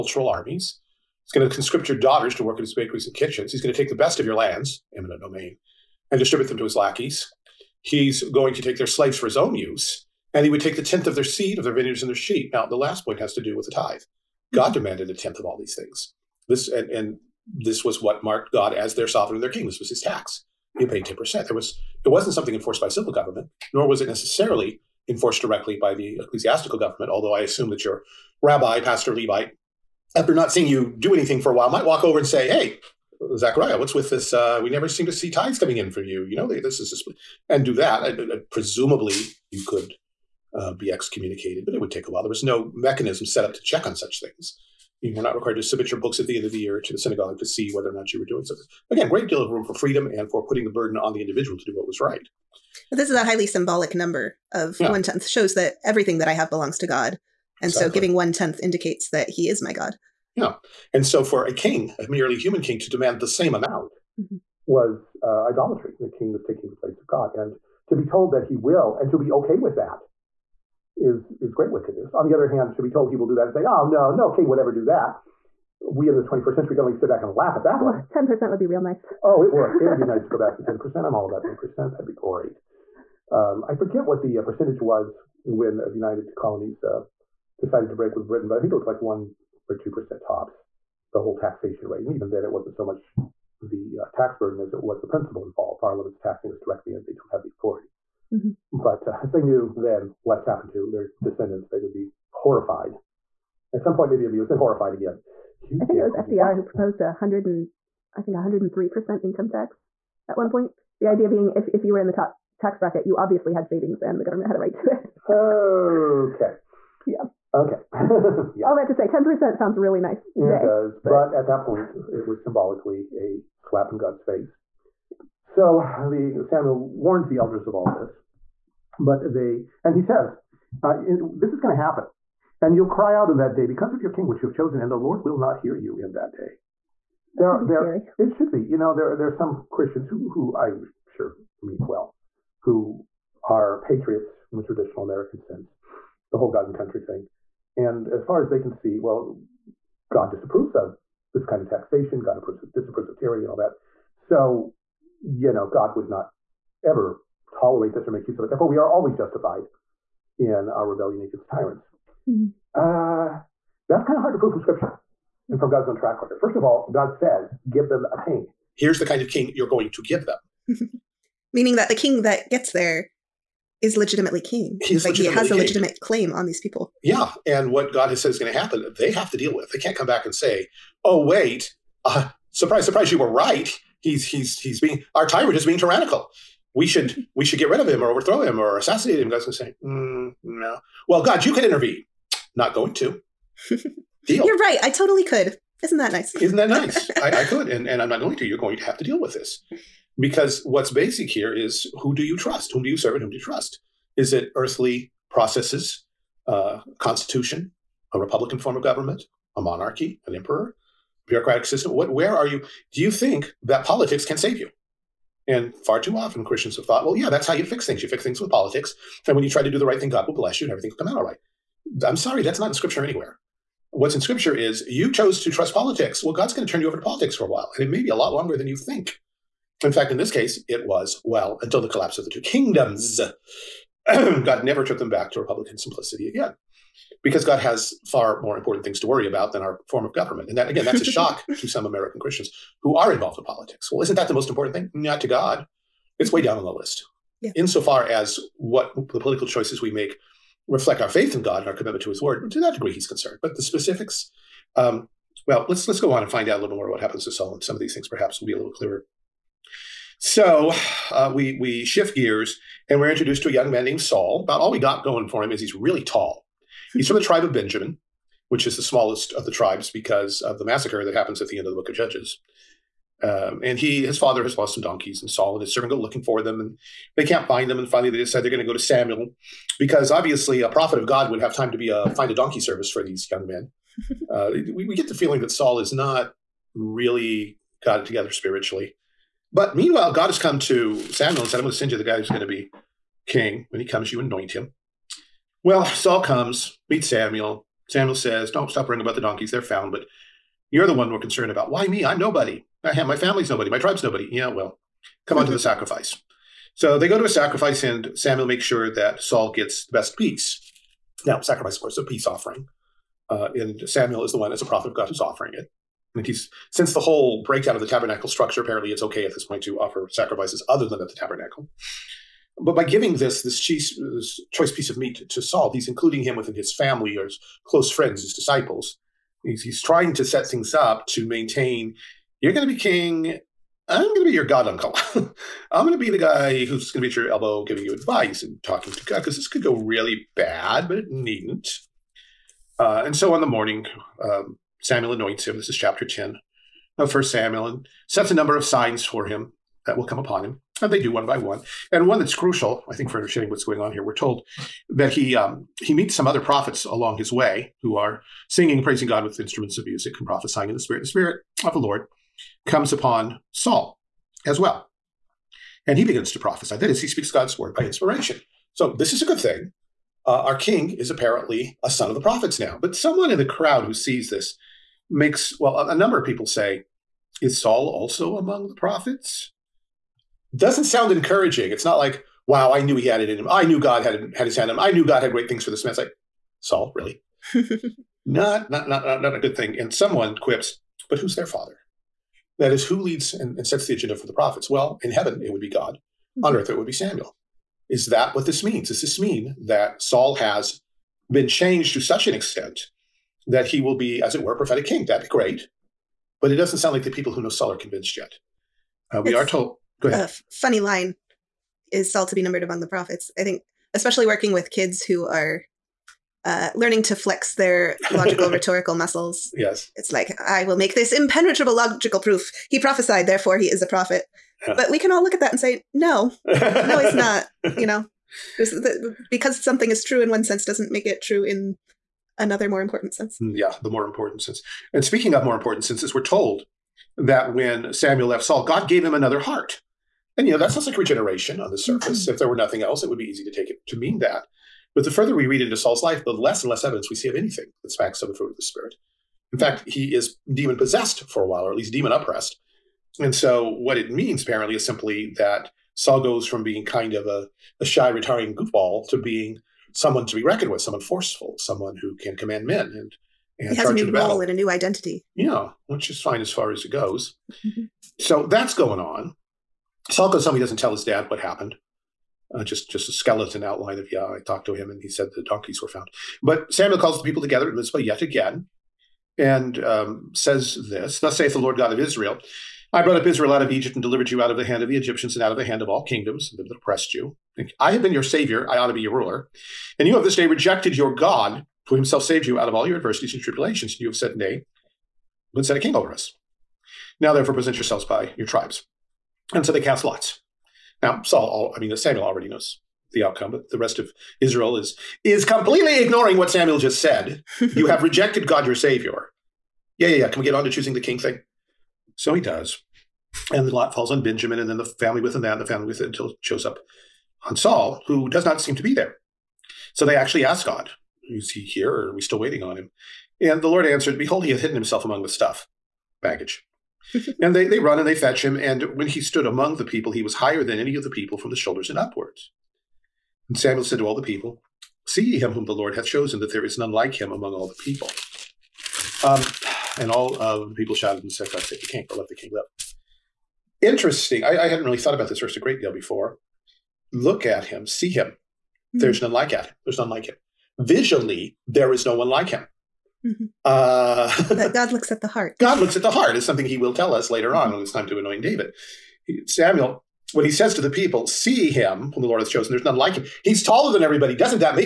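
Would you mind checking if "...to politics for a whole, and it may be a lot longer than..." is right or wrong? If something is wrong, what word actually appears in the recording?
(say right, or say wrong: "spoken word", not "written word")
wrong: "while", not "whole".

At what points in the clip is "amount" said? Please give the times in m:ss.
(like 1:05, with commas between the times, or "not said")
1:03.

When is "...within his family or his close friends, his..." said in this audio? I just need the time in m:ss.
5:26.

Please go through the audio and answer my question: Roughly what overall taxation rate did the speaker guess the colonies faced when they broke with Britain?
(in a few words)
1 or 2 percent.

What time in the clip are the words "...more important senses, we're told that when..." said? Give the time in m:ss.
7:15.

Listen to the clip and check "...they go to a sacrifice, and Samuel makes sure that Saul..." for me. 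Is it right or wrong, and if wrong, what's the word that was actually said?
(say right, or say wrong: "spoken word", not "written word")
right.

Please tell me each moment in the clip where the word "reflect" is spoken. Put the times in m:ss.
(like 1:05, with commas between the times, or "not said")
4:10.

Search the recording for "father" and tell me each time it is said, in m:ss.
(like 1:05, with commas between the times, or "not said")
4:34, 6:31.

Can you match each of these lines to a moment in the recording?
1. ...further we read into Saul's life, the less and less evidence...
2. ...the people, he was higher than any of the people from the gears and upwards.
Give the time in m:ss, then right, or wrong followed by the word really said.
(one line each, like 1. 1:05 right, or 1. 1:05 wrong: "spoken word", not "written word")
1. 7:25 right
2. 8:49 wrong: "shoulders", not "gears".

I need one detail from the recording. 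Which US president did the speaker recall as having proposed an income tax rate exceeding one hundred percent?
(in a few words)
FDR.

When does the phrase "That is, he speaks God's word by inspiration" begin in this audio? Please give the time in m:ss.
6:06.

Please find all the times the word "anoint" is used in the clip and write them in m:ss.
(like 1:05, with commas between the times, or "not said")
4:54, 5:45, 9:18.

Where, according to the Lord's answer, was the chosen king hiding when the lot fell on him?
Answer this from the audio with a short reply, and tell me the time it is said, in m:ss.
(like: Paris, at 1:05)
among the stuff, at 8:45.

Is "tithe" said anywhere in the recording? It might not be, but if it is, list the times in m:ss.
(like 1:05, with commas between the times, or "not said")
0:13, 0:35.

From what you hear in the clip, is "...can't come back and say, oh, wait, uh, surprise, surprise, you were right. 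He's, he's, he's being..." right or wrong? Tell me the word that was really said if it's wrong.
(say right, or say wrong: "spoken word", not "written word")
right.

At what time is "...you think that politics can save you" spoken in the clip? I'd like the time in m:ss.
3:32.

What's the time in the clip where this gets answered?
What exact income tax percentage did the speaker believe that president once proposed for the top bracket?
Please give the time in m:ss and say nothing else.
1:48.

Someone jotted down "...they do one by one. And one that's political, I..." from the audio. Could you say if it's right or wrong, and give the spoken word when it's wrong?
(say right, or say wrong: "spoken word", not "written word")
wrong: "crucial", not "political".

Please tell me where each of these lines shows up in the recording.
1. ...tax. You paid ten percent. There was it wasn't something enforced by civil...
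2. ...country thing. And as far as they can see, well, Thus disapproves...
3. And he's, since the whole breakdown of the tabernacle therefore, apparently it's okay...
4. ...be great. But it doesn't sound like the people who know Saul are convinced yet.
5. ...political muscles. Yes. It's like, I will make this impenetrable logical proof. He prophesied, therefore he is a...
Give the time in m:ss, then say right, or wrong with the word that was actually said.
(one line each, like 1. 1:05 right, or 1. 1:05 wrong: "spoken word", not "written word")
1. 0:19 right
2. 2:26 wrong: "God", not "Thus"
3. 5:16 wrong: "structure", not "therefore"
4. 6:45 right
5. 6:58 wrong: "rhetorical", not "political".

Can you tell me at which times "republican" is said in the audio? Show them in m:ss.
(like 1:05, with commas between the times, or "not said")
3:28, 3:55.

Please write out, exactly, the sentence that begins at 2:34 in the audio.
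So you know, God would not ever tolerate this or make use of it.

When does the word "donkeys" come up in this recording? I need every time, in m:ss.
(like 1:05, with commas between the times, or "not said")
4:34, 4:42, 4:59, 7:55.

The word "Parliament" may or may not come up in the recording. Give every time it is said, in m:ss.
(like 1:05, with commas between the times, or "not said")
1:35.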